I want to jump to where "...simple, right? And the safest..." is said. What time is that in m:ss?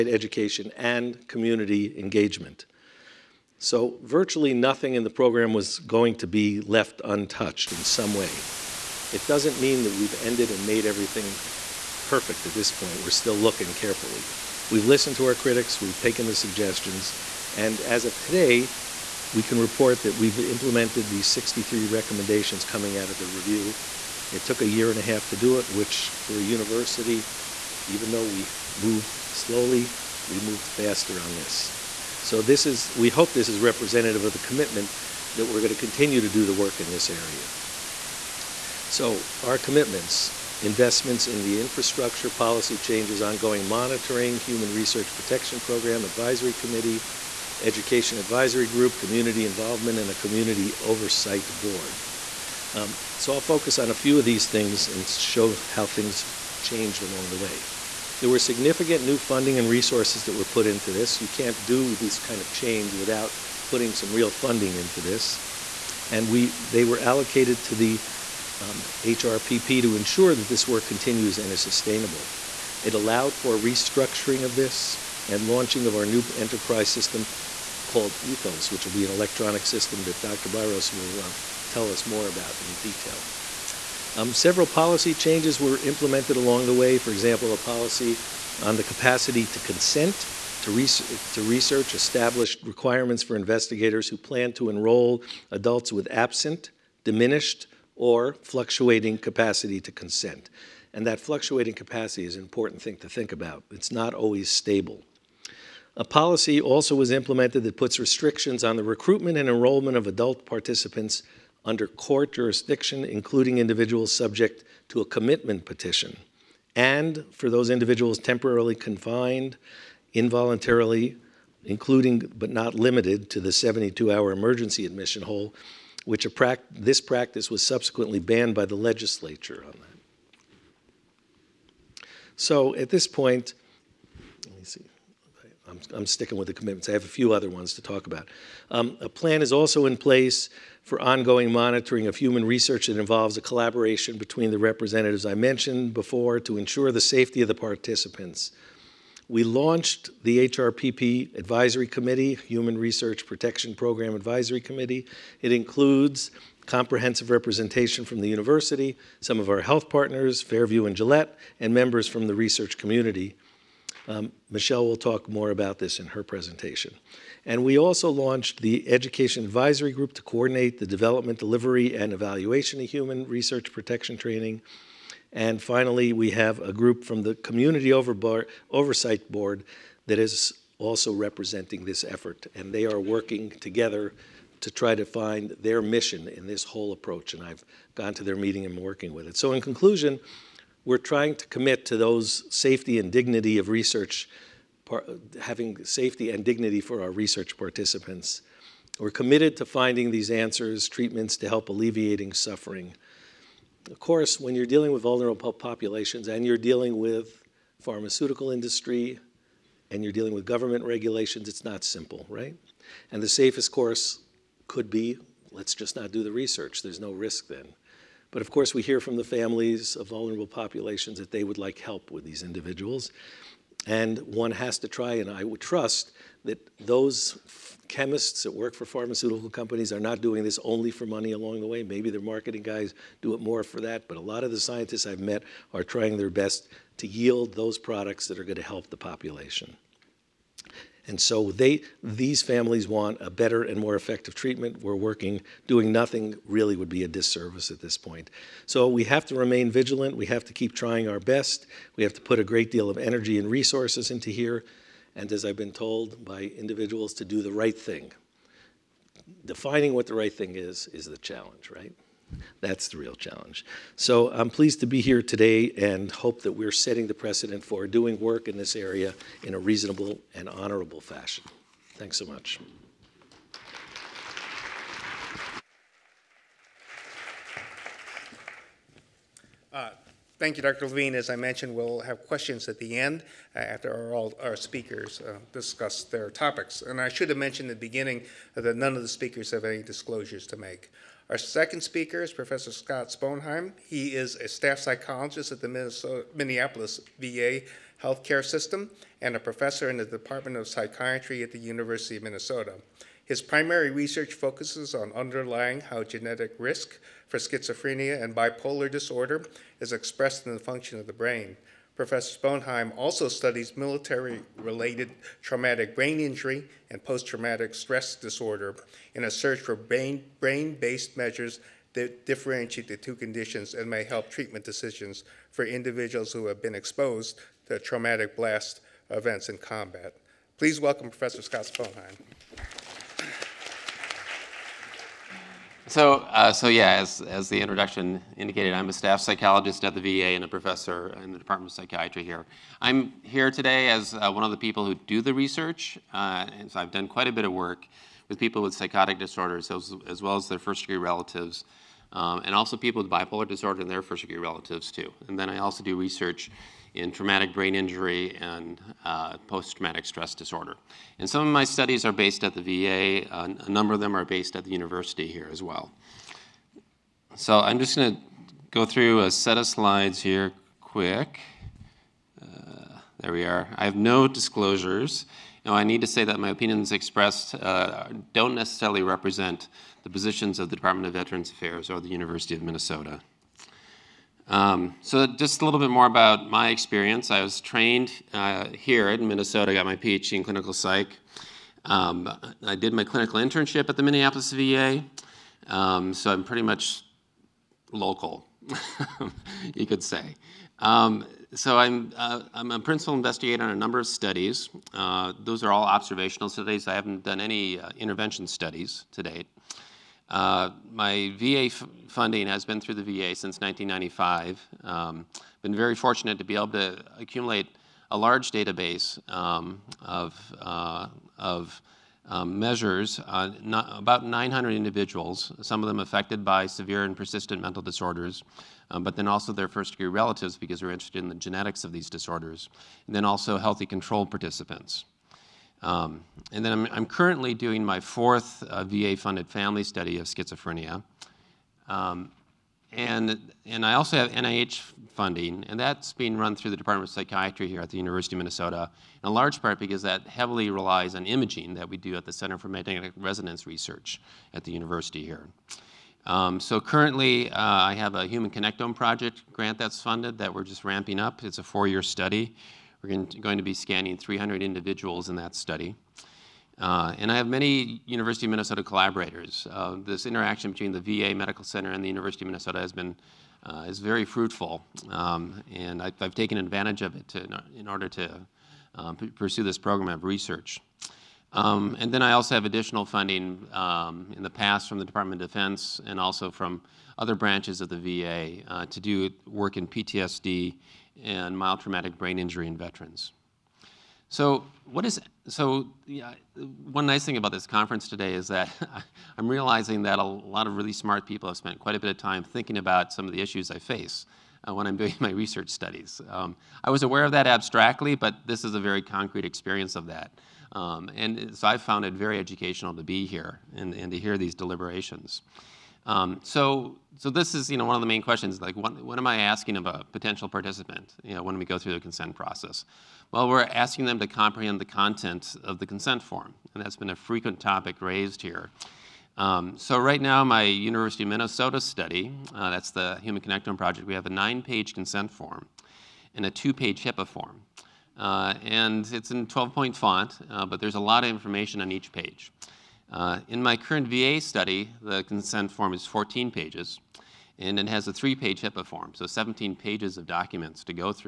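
3:31.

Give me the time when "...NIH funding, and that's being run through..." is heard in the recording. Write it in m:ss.
7:24.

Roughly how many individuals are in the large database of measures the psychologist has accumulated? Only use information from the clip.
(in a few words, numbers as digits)
900.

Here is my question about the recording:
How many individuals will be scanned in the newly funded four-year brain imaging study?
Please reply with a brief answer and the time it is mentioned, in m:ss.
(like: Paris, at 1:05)
300, at 7:44.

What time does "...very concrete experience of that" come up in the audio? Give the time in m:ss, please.
8:28.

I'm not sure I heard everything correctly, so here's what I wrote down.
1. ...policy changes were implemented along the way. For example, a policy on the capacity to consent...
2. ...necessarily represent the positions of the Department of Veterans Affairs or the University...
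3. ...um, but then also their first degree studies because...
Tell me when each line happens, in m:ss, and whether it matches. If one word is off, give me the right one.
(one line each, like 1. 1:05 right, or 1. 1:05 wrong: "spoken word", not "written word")
1. 1:24 right
2. 6:18 right
3. 7:08 wrong: "relatives", not "studies".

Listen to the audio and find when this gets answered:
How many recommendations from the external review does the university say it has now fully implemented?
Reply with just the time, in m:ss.
0:21.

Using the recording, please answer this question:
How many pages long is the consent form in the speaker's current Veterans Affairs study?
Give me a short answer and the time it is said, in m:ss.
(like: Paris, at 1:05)
14, at 9:06.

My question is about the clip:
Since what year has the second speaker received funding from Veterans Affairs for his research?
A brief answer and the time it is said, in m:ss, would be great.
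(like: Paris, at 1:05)
1995, at 6:53.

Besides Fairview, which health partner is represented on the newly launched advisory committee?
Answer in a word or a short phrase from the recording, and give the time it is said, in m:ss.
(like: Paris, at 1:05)
Gillette, at 2:40.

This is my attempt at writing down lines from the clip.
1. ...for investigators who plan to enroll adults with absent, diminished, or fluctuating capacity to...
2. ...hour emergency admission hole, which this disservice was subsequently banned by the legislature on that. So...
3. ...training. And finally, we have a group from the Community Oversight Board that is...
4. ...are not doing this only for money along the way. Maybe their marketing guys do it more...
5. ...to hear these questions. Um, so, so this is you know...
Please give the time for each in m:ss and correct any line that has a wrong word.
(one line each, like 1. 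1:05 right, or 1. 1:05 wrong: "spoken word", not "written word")
1. 1:33 right
2. 2:04 wrong: "practice", not "disservice"
3. 2:54 right
4. 3:49 right
5. 8:34 wrong: "deliberations", not "questions".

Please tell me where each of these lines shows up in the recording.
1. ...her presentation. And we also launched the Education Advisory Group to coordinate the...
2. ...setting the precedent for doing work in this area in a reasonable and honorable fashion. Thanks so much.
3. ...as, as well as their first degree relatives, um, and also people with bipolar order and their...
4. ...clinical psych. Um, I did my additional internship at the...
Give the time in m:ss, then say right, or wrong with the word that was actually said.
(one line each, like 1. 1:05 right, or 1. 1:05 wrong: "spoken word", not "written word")
1. 2:46 right
2. 4:26 right
3. 5:49 wrong: "disorder", not "order"
4. 6:30 wrong: "clinical", not "additional".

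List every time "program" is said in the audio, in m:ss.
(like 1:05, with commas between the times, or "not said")
0:05, 0:45, 2:33, 7:59.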